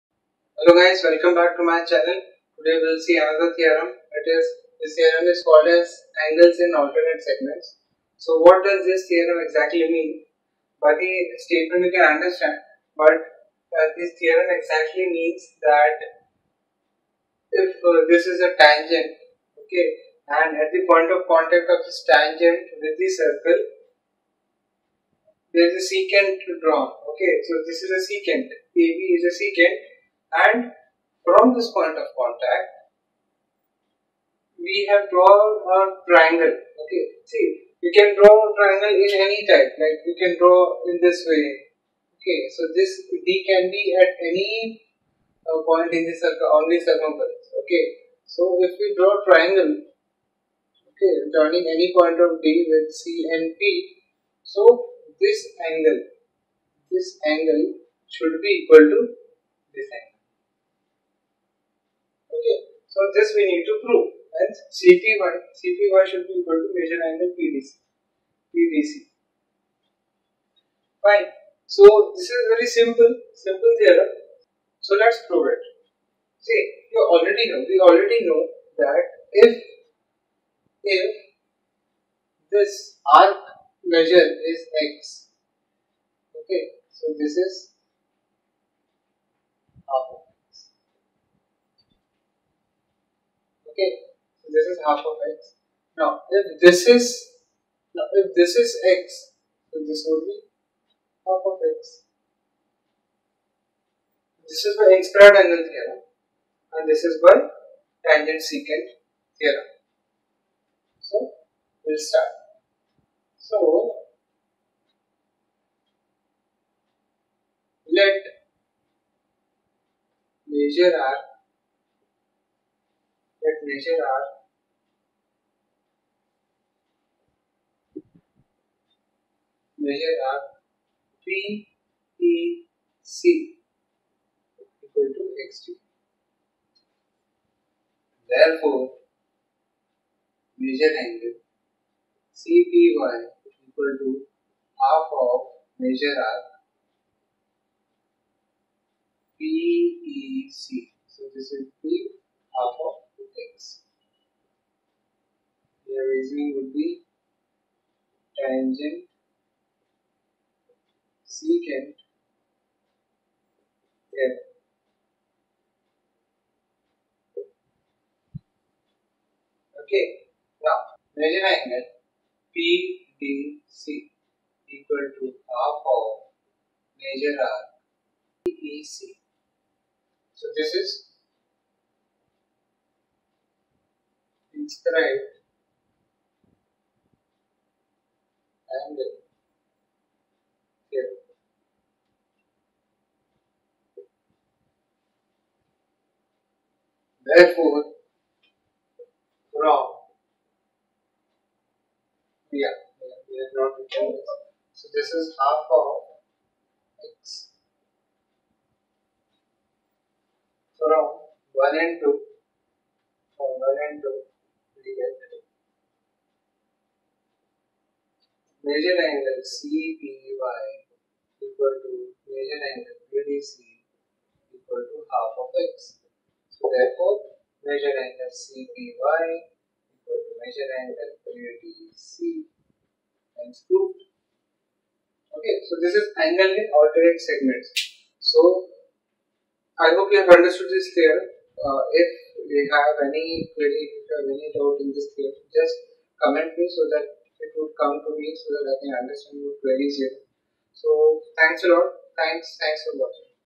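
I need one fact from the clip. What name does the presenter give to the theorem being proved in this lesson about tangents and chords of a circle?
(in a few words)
Angles in alternate segments.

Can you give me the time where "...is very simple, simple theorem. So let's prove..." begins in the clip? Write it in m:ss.
1:12.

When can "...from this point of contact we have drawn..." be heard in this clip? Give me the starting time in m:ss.
0:31.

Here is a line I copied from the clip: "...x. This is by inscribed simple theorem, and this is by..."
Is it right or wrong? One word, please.
wrong.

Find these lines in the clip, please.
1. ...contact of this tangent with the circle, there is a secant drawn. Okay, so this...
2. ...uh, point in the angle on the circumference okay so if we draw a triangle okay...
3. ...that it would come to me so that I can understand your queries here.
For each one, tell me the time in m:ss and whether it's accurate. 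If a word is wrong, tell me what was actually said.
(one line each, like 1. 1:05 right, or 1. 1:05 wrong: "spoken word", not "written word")
1. 0:21 right
2. 0:45 wrong: "circle", not "angle"
3. 4:06 right.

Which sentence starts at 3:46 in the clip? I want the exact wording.
So therefore, measure angle CPY equal to measure angle BDC times 2.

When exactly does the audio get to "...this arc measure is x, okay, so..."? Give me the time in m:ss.
1:22.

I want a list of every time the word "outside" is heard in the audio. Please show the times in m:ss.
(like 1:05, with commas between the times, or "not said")
not said.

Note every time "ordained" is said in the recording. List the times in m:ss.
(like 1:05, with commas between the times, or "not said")
not said.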